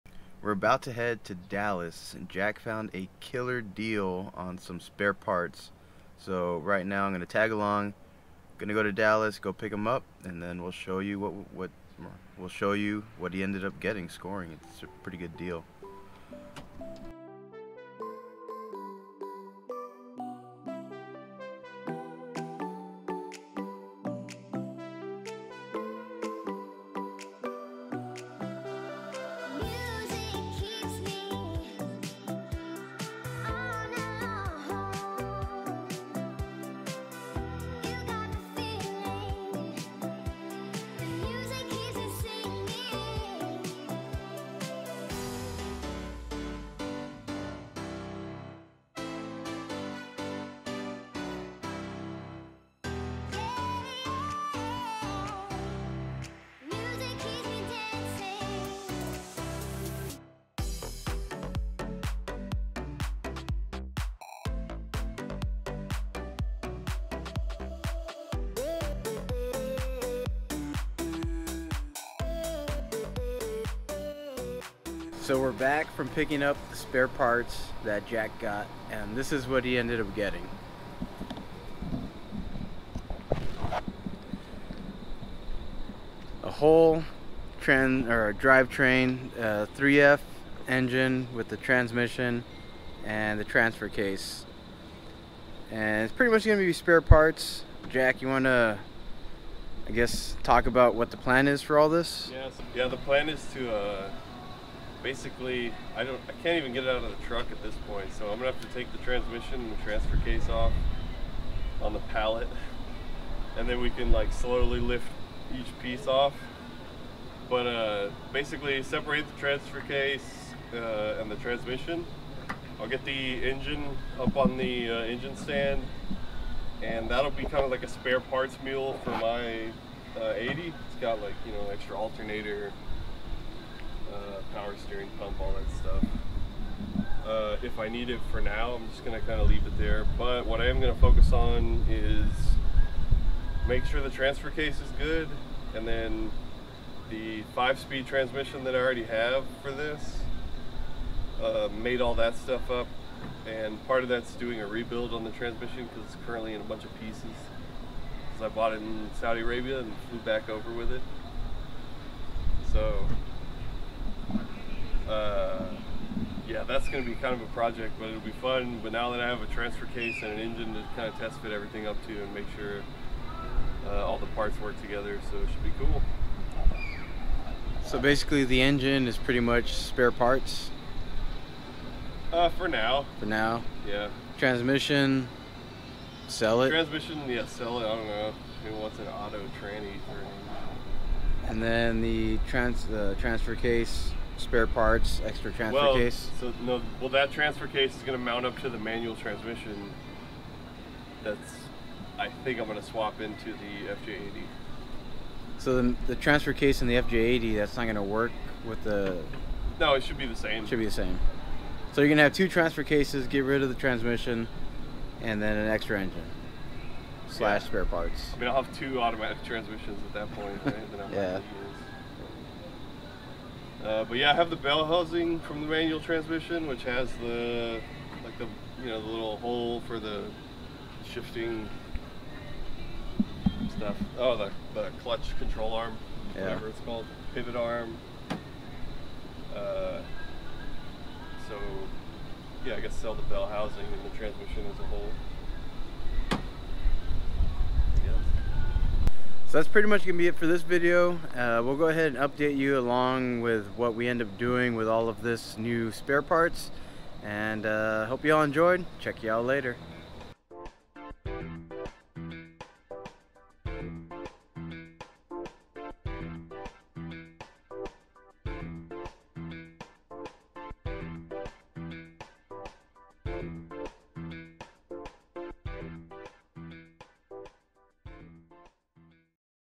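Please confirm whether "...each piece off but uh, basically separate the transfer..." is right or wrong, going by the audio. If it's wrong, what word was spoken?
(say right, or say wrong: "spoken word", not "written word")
right.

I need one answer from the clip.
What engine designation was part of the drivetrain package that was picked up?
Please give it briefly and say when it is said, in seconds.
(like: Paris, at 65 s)
3F, at 89 s.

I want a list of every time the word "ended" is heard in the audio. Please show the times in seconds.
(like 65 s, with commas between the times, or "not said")
13 s, 79 s.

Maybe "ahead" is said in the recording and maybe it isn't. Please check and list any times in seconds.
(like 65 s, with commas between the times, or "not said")
251 s.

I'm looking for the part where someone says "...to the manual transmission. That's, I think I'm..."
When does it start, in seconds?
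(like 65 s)
198 s.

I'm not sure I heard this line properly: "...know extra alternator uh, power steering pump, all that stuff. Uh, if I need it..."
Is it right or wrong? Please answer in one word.
right.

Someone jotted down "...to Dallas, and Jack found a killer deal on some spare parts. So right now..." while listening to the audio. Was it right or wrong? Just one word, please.
right.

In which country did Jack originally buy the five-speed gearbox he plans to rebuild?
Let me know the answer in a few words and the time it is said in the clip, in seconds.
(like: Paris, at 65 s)
Saudi Arabia, at 159 s.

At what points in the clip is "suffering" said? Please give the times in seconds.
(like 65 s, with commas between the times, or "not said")
not said.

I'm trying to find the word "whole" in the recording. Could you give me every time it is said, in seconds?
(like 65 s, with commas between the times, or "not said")
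86 s, 244 s.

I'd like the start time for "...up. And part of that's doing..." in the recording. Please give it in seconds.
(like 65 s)
152 s.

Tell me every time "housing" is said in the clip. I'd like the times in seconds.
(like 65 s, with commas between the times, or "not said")
224 s, 243 s.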